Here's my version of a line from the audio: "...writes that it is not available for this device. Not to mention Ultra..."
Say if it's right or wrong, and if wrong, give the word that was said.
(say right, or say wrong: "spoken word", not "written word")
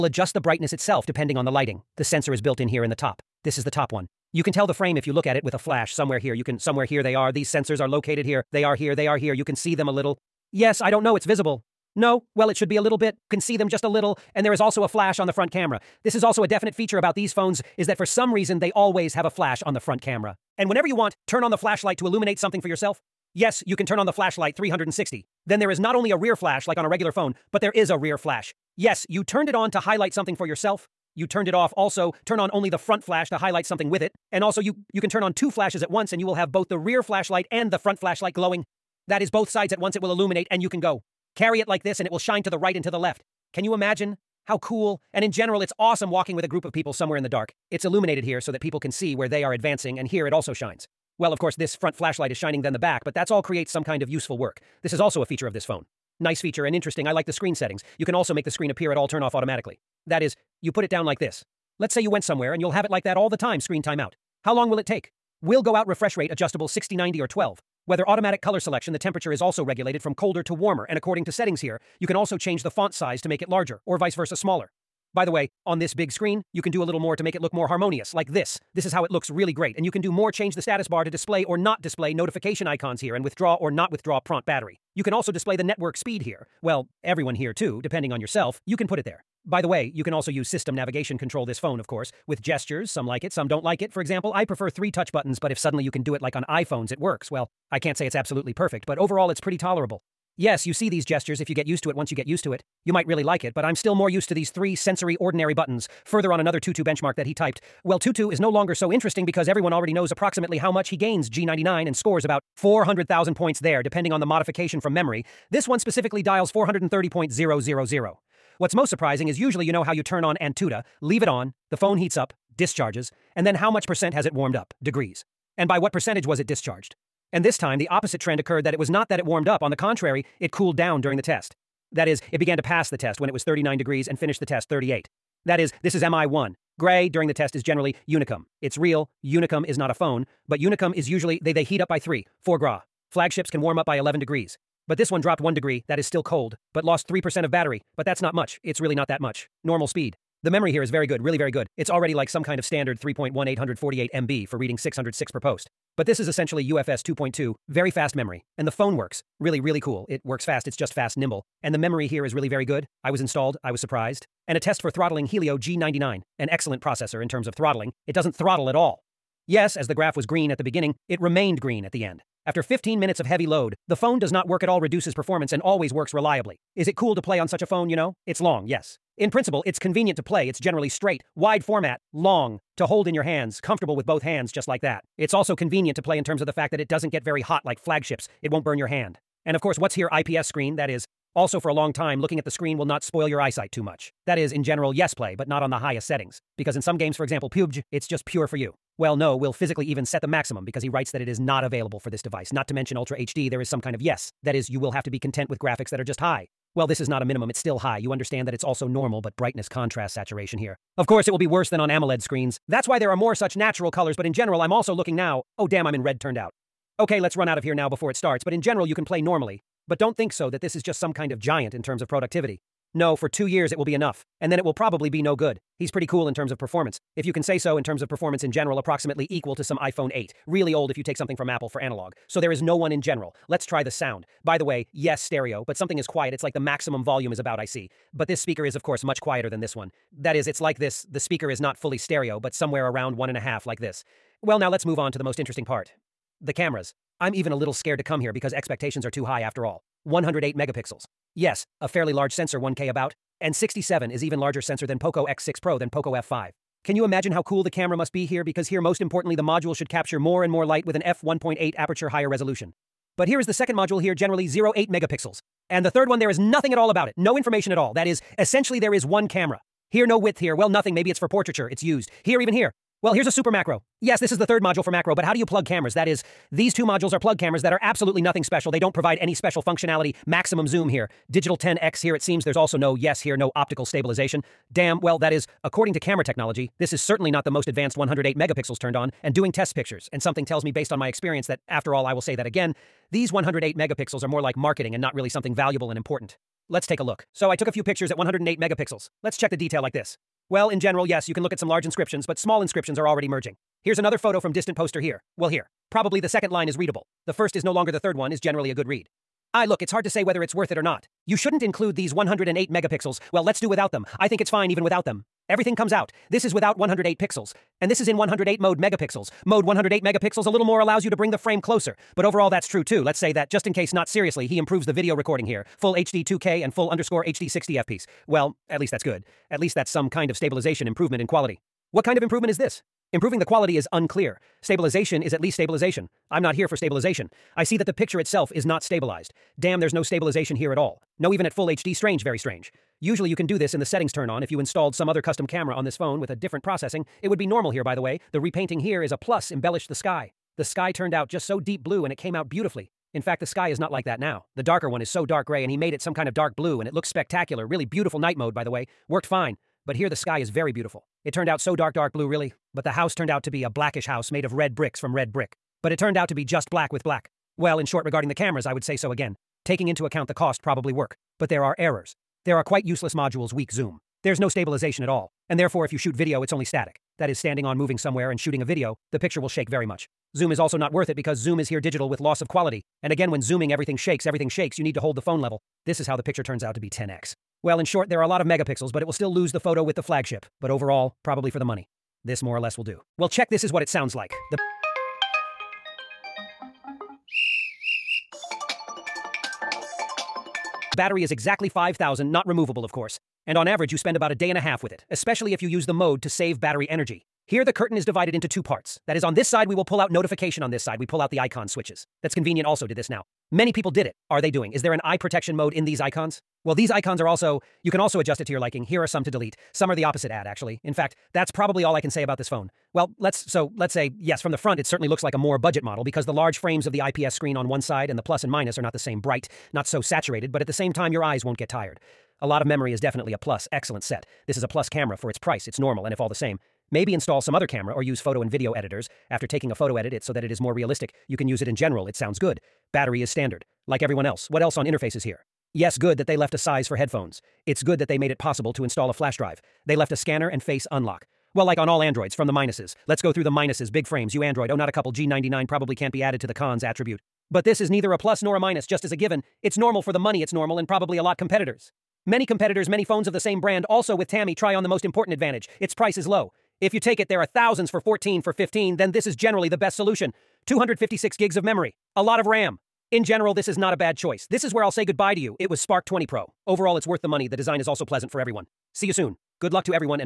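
right.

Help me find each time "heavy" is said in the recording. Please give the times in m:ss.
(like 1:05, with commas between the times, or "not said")
2:53.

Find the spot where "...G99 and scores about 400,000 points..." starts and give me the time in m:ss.
1:51.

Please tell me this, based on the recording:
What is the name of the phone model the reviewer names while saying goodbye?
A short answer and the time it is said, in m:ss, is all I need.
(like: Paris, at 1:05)
Spark 20 Pro, at 7:55.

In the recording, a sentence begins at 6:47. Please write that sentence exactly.
Here the curtain is divided into two parts.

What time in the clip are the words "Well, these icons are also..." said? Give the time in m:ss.
6:56.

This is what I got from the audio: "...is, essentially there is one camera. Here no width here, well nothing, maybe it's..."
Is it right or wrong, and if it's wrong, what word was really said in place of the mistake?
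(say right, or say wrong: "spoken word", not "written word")
right.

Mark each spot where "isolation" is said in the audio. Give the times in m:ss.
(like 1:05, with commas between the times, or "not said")
not said.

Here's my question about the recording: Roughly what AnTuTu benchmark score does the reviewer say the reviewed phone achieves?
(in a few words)
430,000.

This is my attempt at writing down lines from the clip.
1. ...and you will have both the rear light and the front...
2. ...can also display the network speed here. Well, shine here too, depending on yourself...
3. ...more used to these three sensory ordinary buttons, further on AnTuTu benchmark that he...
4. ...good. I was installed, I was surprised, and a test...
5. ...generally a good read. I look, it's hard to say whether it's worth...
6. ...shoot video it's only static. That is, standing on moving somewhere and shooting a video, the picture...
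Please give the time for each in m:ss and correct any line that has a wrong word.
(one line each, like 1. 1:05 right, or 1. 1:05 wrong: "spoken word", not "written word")
1. 0:36 wrong: "flashlight", not "light"
2. 1:25 wrong: "everyone", not "shine"
3. 1:43 right
4. 2:42 right
5. 5:08 right
6. 6:15 right.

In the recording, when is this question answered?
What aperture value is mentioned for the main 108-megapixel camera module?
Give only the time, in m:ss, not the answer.
4:21.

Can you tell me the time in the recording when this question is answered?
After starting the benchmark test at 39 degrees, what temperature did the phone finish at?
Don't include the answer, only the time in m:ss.
2:14.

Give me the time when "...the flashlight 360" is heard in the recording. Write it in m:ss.
0:24.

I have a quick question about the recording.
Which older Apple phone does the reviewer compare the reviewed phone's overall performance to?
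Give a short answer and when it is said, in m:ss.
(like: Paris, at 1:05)
iPhone 8, at 3:49.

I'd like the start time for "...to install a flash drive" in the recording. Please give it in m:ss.
7:28.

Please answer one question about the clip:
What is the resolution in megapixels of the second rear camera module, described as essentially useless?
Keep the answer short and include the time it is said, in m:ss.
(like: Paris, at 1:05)
0.8, at 4:24.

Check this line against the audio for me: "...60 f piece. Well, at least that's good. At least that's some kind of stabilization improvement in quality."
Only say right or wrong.
right.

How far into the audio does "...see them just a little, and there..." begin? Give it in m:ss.
0:13.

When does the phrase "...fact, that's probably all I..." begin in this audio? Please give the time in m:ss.
7:00.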